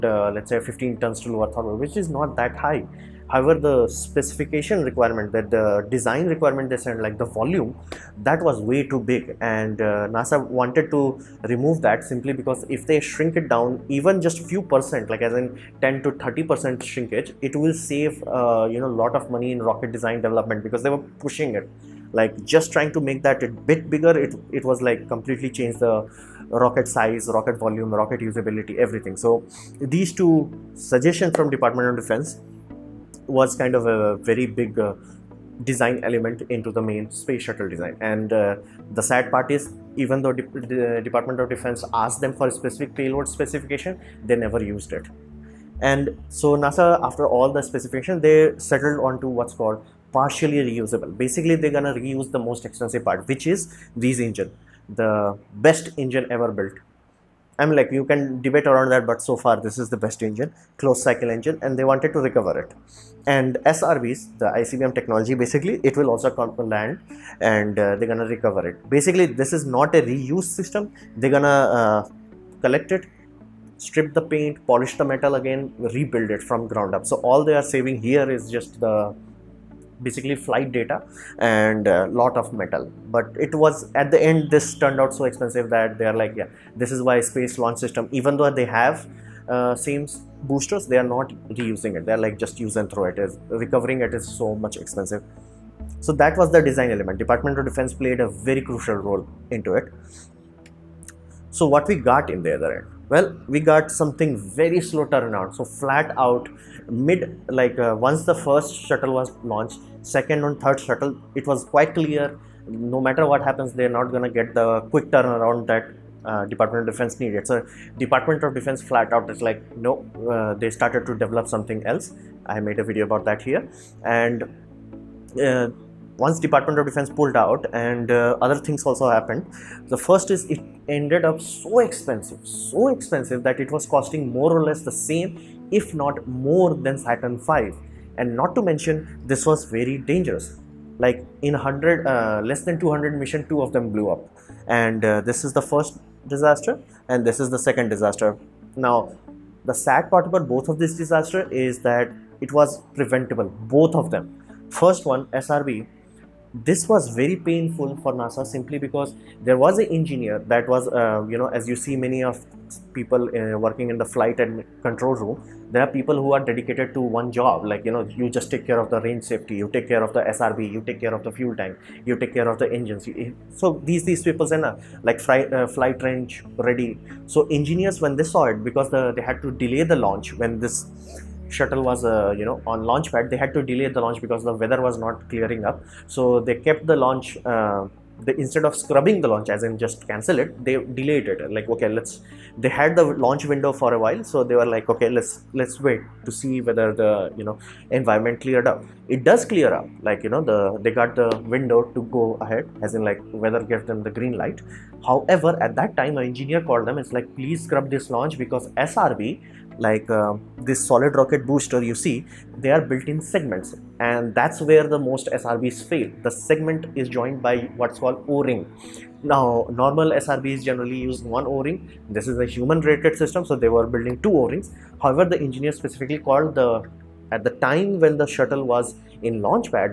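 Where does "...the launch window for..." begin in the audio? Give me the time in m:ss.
3:12.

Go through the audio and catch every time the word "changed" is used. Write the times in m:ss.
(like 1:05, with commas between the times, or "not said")
0:25.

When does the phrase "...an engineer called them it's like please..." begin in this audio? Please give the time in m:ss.
3:26.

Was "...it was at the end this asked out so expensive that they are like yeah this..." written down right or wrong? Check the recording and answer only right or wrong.
wrong.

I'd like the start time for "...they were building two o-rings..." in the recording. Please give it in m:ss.
3:43.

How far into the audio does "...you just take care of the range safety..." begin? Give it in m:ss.
2:48.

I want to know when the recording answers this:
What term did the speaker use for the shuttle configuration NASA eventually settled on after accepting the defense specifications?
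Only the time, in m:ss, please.
0:50.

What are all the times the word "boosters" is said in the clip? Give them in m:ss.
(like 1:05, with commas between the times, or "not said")
1:30, 3:31.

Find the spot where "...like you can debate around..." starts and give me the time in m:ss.
0:57.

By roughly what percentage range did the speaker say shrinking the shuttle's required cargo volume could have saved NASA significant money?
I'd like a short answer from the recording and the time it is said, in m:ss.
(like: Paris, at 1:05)
10 to 30 percent, at 0:15.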